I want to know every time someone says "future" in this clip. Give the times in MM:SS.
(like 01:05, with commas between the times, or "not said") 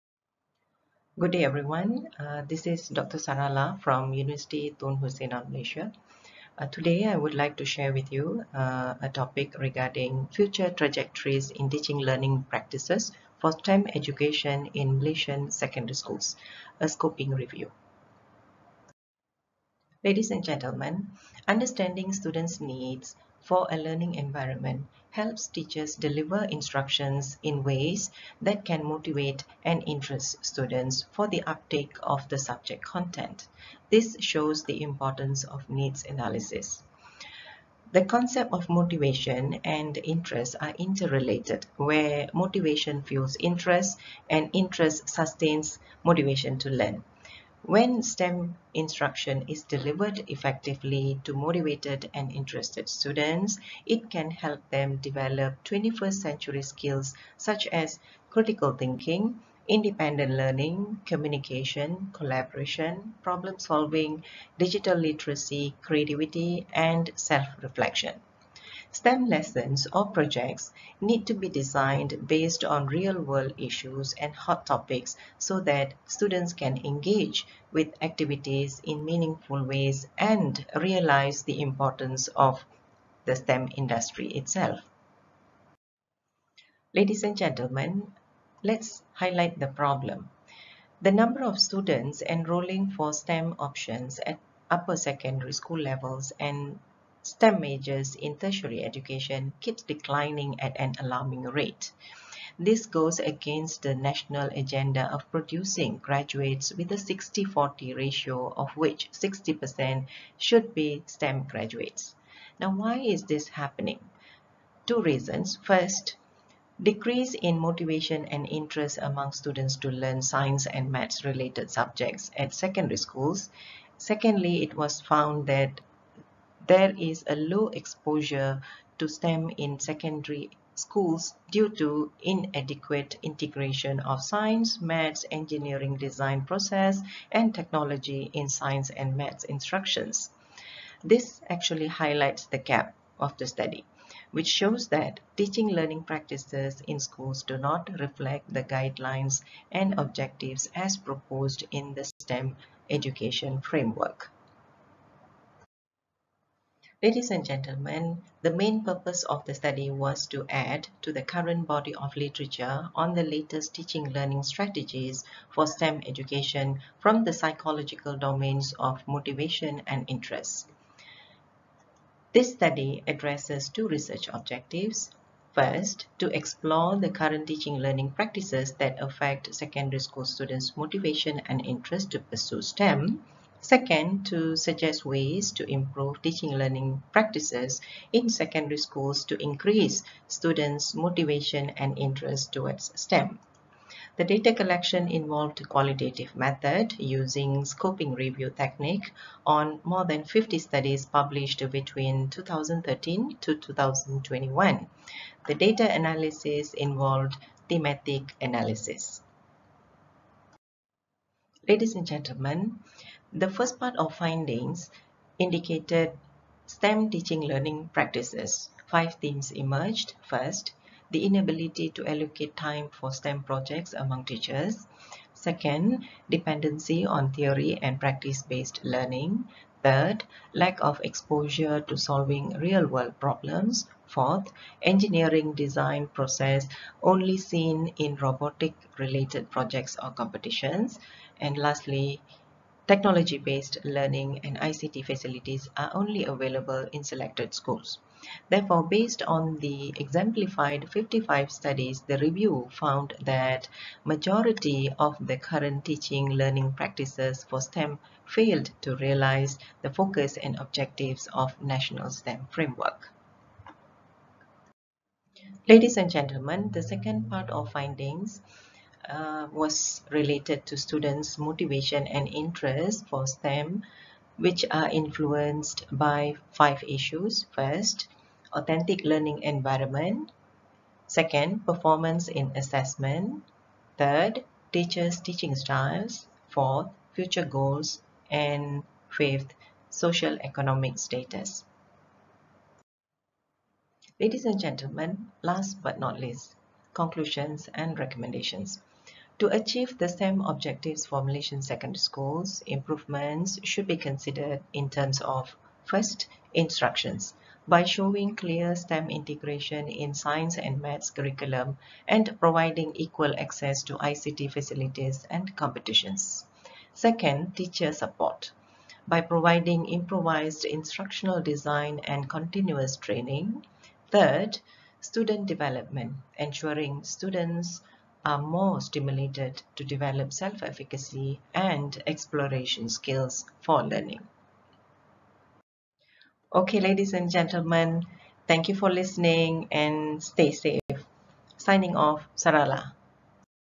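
00:10, 04:47.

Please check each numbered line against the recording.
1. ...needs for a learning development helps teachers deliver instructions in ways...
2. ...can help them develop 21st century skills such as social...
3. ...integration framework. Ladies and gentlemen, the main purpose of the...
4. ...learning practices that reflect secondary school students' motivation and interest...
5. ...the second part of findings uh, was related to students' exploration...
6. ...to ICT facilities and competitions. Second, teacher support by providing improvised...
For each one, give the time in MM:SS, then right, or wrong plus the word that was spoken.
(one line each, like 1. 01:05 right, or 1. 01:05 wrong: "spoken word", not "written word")
1. 00:22 wrong: "environment", not "development"
2. 00:54 wrong: "critical", not "social"
3. 02:32 wrong: "education", not "integration"
4. 02:57 wrong: "affect", not "reflect"
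5. 04:26 wrong: "motivation", not "exploration"
6. 05:13 right.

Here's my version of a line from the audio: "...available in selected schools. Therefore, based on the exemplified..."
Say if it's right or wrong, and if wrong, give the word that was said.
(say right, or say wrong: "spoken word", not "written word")
right.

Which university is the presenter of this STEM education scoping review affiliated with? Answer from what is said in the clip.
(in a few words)
University Tun Hussein Onn Malaysia.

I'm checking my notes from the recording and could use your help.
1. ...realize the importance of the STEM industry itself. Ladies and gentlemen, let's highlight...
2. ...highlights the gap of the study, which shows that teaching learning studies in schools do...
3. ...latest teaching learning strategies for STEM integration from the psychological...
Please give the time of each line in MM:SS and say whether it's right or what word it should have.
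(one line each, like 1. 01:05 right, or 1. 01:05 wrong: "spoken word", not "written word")
1. 01:20 right
2. 02:21 wrong: "practices", not "studies"
3. 02:43 wrong: "education", not "integration".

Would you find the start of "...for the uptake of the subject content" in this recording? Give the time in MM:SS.
00:31.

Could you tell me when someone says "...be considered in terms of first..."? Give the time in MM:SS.
05:03.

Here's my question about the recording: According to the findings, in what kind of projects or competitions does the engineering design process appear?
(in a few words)
robotic-related.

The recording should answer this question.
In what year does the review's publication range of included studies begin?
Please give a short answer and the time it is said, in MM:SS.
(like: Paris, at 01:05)
2013, at 03:22.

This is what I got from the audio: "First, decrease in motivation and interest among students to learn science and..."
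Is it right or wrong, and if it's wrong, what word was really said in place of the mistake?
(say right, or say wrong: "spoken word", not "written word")
right.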